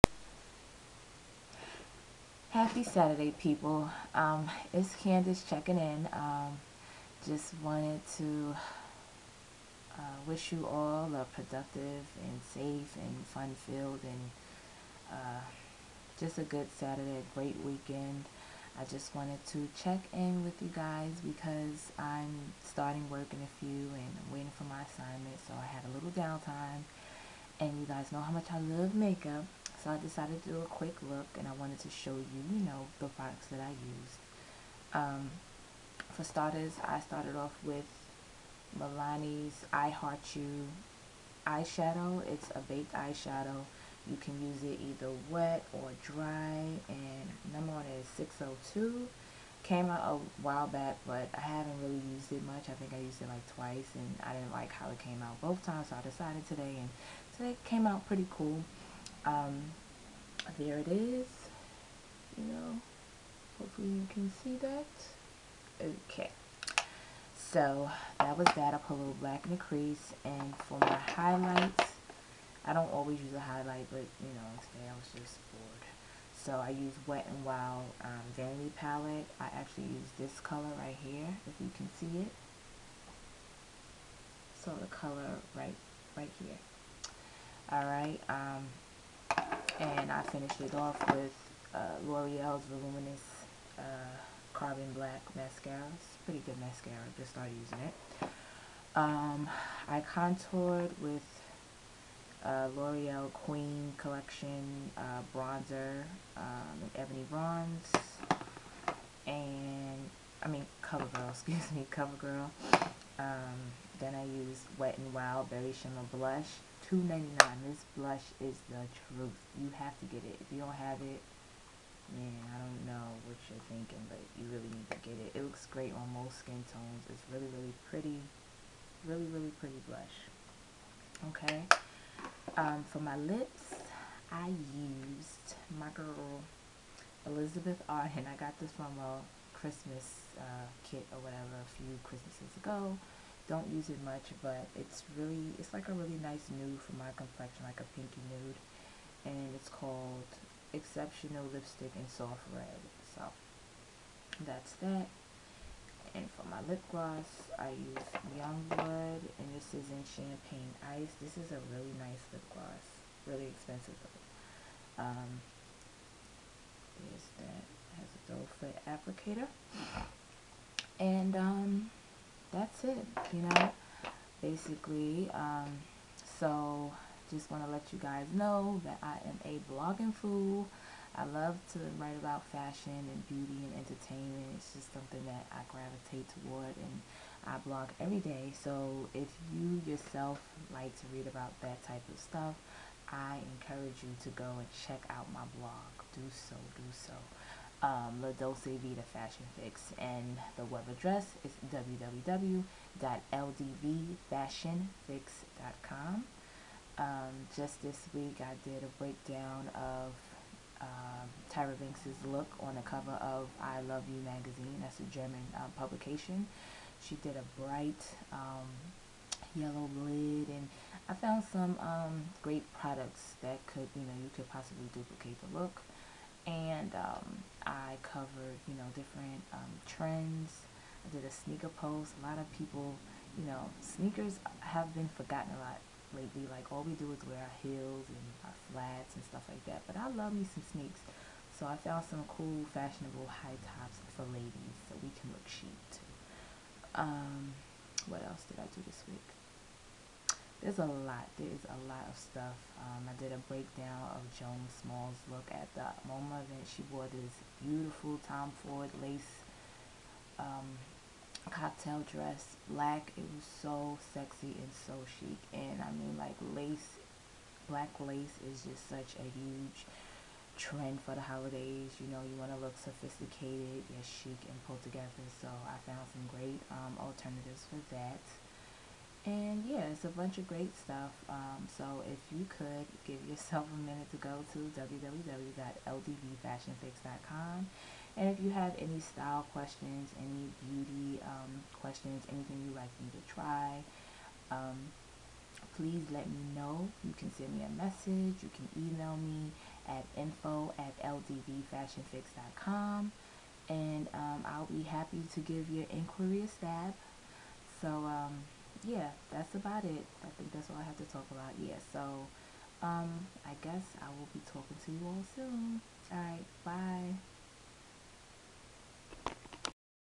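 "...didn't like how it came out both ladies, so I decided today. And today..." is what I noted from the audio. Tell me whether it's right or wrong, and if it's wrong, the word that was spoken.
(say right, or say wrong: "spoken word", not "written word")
wrong: "times", not "ladies".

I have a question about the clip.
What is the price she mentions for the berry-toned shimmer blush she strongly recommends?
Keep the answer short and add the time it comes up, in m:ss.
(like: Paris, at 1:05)
$2.99, at 1:56.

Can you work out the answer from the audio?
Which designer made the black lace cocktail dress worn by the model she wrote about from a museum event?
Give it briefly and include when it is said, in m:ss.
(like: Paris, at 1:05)
Tom Ford, at 4:18.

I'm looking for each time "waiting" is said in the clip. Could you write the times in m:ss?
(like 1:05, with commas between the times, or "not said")
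0:24.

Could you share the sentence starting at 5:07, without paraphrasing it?
So, um, yeah, that's about it.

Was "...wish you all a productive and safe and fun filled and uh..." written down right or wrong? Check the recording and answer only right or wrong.
right.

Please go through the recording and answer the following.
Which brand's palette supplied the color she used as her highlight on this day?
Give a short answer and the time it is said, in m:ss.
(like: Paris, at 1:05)
Wet and Wild, at 1:17.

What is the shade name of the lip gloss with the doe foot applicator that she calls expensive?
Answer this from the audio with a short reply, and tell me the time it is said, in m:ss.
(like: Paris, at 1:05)
Champagne Ice, at 2:40.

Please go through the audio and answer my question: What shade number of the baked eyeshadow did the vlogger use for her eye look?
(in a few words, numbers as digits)
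602.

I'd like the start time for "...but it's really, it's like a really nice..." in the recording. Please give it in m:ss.
2:24.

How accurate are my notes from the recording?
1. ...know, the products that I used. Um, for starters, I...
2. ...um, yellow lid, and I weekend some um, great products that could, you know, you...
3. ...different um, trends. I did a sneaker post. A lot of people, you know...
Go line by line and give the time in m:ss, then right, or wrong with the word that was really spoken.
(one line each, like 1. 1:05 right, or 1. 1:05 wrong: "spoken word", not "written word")
1. 0:32 right
2. 3:38 wrong: "found", not "weekend"
3. 3:48 right.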